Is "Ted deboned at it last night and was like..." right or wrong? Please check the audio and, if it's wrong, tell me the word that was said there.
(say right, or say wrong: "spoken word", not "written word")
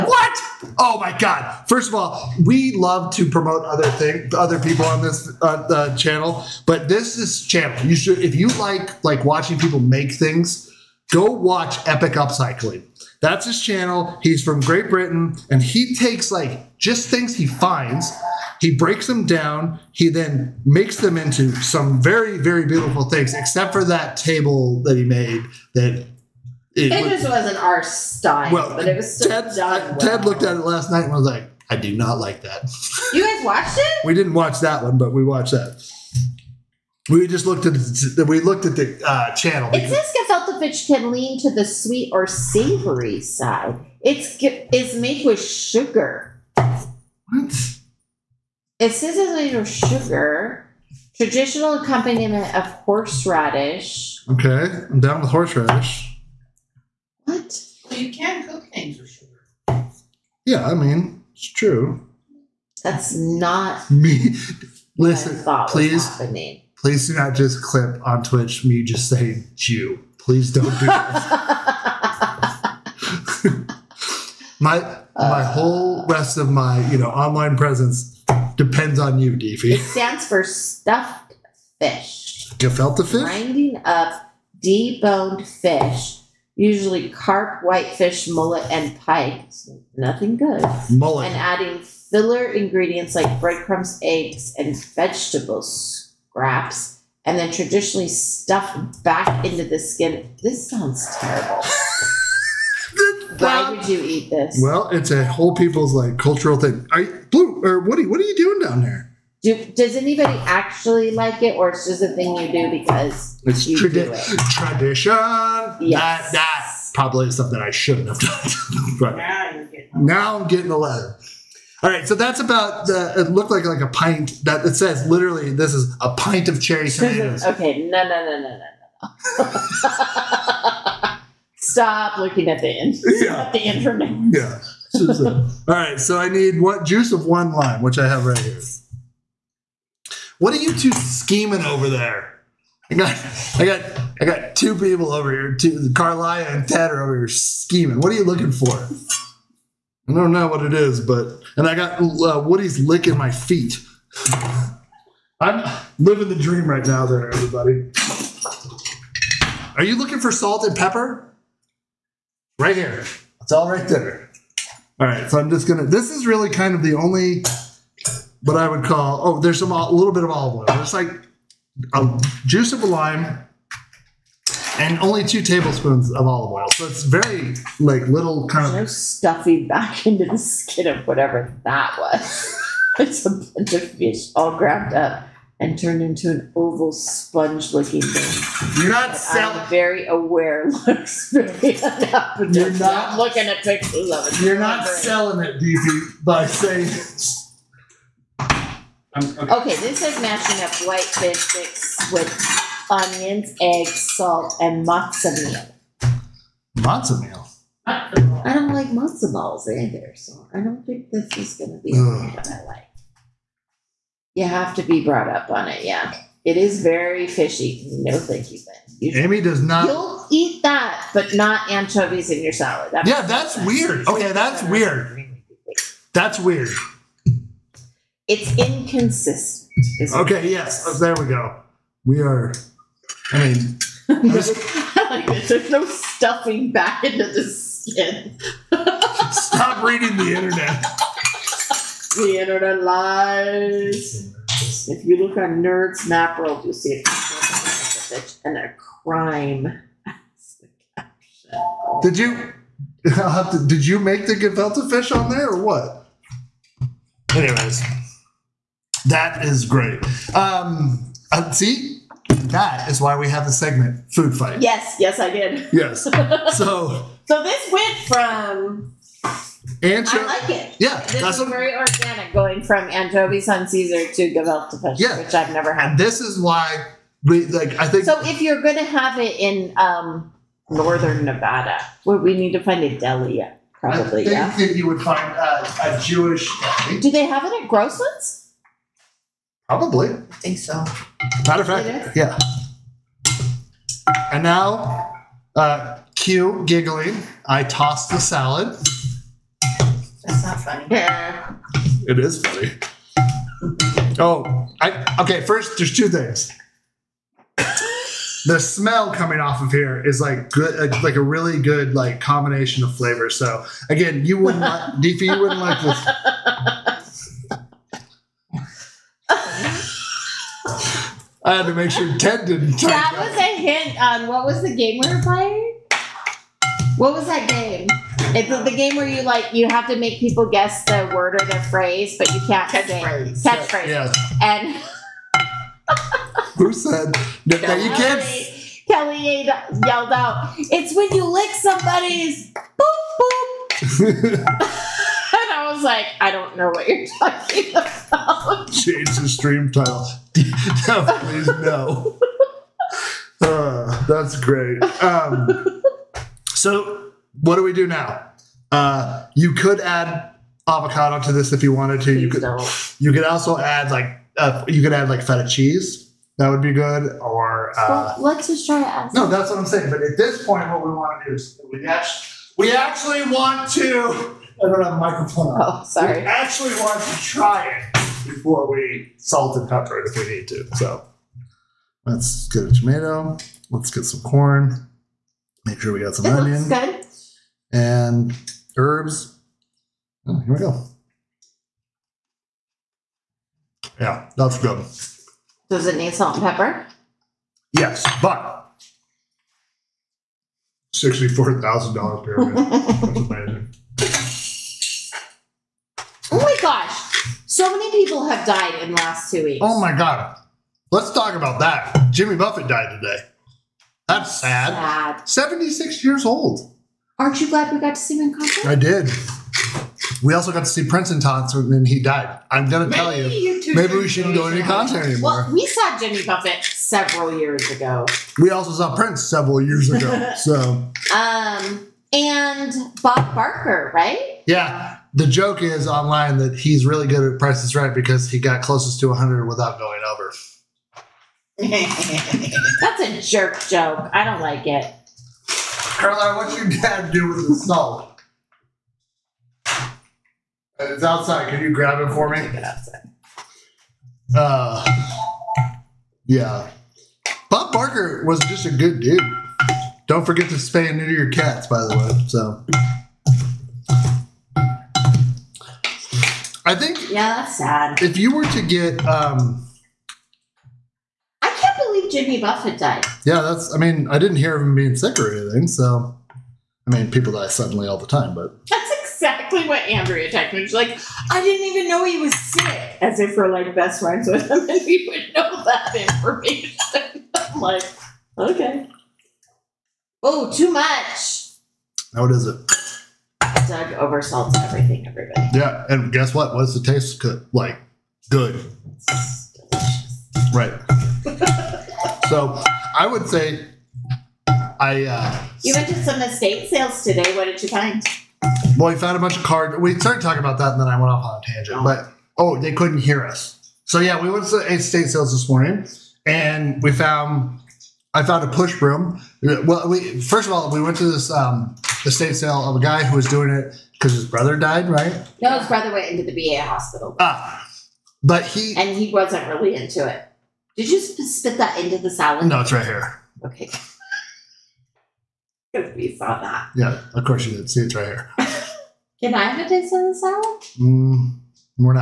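wrong: "looked", not "deboned".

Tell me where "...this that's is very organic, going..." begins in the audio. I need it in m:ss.
4:31.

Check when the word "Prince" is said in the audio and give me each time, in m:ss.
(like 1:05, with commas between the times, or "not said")
7:00, 7:08.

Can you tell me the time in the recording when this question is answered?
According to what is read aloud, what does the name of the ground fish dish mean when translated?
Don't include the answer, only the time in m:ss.
1:20.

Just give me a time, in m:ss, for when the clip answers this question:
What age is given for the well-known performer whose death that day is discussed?
6:55.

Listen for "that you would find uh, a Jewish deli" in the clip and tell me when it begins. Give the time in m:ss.
4:44.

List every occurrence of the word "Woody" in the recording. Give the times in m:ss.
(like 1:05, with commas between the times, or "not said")
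1:47, 2:32.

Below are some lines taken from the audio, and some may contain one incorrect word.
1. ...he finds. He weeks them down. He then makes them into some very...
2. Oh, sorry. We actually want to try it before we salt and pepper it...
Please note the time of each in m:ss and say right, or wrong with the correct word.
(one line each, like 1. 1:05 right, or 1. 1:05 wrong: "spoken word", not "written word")
1. 0:17 wrong: "breaks", not "weeks"
2. 6:15 right.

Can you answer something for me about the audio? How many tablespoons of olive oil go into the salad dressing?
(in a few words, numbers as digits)
2.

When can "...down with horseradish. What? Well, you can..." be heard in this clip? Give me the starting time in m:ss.
0:54.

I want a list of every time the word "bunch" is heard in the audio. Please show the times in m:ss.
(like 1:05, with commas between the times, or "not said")
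3:03, 8:29.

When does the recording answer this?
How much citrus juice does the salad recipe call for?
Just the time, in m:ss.
2:16.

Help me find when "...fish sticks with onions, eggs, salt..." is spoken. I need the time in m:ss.
3:21.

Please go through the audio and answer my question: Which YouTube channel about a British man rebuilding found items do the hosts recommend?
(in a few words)
Epic Upcycling.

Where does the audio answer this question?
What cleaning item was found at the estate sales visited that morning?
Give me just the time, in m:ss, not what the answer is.
8:38.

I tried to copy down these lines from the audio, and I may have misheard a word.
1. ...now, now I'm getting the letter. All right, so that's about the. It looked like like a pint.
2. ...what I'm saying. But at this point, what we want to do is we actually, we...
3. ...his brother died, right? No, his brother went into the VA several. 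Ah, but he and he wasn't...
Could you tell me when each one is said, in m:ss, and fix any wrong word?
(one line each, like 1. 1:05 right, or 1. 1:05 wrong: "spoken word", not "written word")
1. 1:59 right
2. 6:09 right
3. 8:44 wrong: "hospital", not "several".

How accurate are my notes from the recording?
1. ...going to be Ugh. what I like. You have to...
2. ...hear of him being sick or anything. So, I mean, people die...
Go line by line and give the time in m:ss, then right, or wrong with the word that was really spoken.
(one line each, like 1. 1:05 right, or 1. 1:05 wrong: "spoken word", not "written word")
1. 3:31 right
2. 7:54 right.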